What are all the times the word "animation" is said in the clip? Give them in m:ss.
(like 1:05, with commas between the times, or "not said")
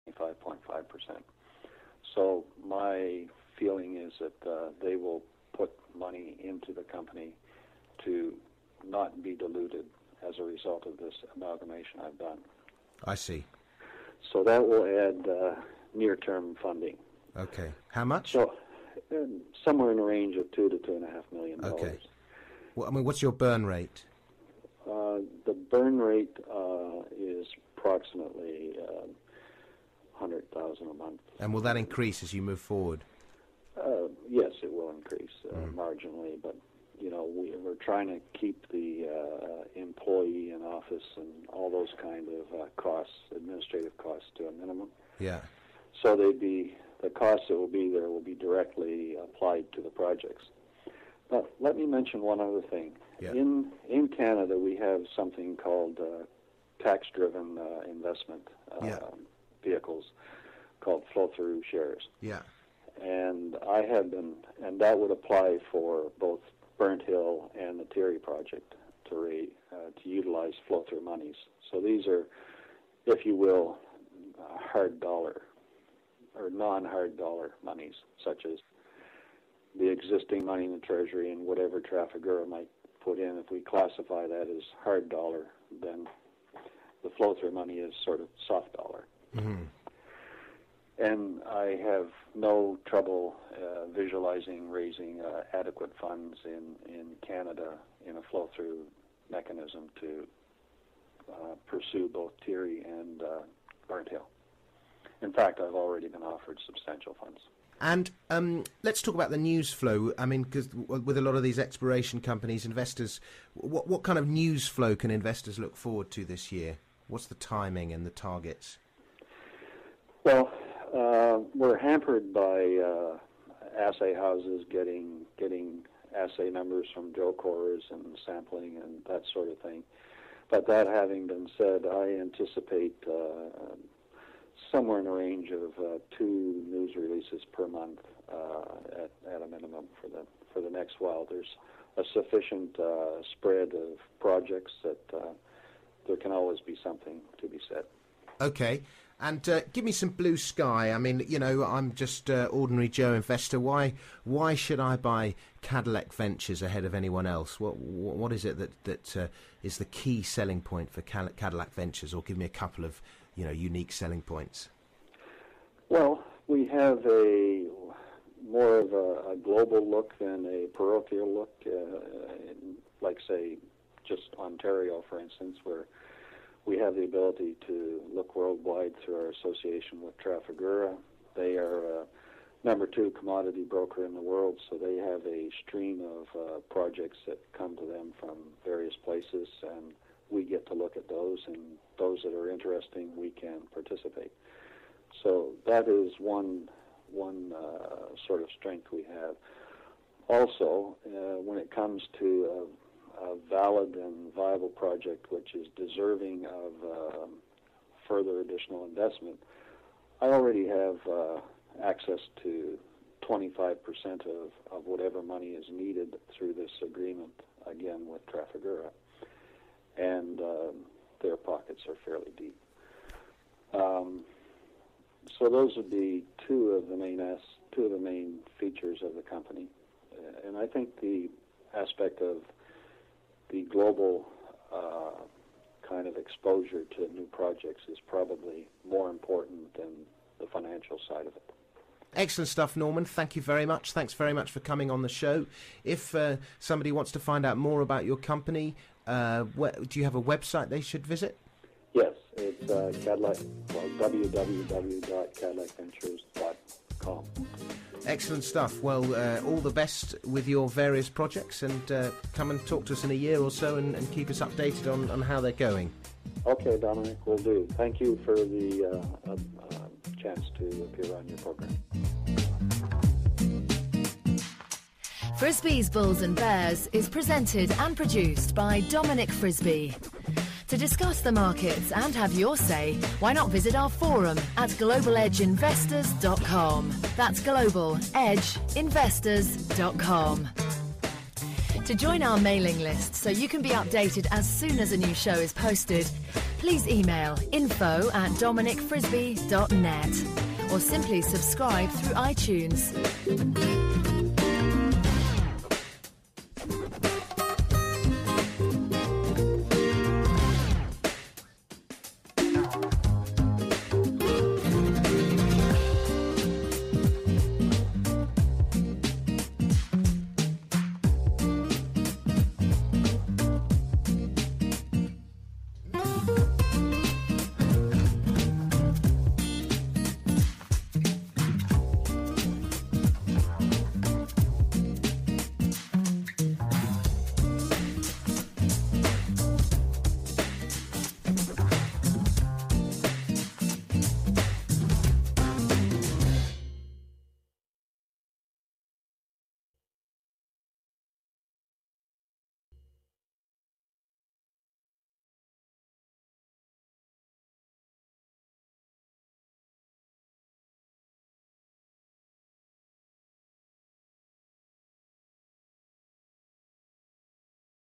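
not said.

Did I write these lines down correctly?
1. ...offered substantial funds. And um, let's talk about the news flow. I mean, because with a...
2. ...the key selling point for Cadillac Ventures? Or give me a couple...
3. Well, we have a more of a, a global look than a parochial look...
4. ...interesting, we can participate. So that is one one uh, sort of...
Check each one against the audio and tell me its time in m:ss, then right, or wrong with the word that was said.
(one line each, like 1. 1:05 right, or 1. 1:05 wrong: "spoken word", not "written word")
1. 1:46 right
2. 2:39 right
3. 2:45 right
4. 3:12 right.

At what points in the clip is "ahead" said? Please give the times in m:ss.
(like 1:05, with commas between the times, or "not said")
2:36.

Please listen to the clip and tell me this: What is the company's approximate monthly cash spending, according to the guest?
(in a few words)
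100,000 a month.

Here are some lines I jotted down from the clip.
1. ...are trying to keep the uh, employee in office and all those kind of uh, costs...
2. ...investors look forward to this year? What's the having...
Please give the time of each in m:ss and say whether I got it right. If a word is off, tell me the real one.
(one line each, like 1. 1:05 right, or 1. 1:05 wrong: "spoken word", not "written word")
1. 0:37 right
2. 1:55 wrong: "timing", not "having".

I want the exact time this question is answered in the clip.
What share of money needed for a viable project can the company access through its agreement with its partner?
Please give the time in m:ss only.
3:33.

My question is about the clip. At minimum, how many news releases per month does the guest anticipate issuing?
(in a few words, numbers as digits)
2.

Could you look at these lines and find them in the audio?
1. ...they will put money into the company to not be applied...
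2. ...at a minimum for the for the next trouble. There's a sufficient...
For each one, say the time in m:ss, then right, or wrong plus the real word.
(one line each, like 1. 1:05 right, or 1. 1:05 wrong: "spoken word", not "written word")
1. 0:04 wrong: "diluted", not "applied"
2. 2:19 wrong: "while", not "trouble".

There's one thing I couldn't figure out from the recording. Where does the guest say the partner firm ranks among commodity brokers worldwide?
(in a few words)
number 2.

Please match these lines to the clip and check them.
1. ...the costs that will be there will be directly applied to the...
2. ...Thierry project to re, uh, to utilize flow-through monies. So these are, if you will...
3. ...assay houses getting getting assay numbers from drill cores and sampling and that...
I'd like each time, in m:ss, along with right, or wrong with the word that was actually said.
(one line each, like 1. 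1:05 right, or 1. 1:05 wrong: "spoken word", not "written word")
1. 0:47 right
2. 1:07 right
3. 2:03 right.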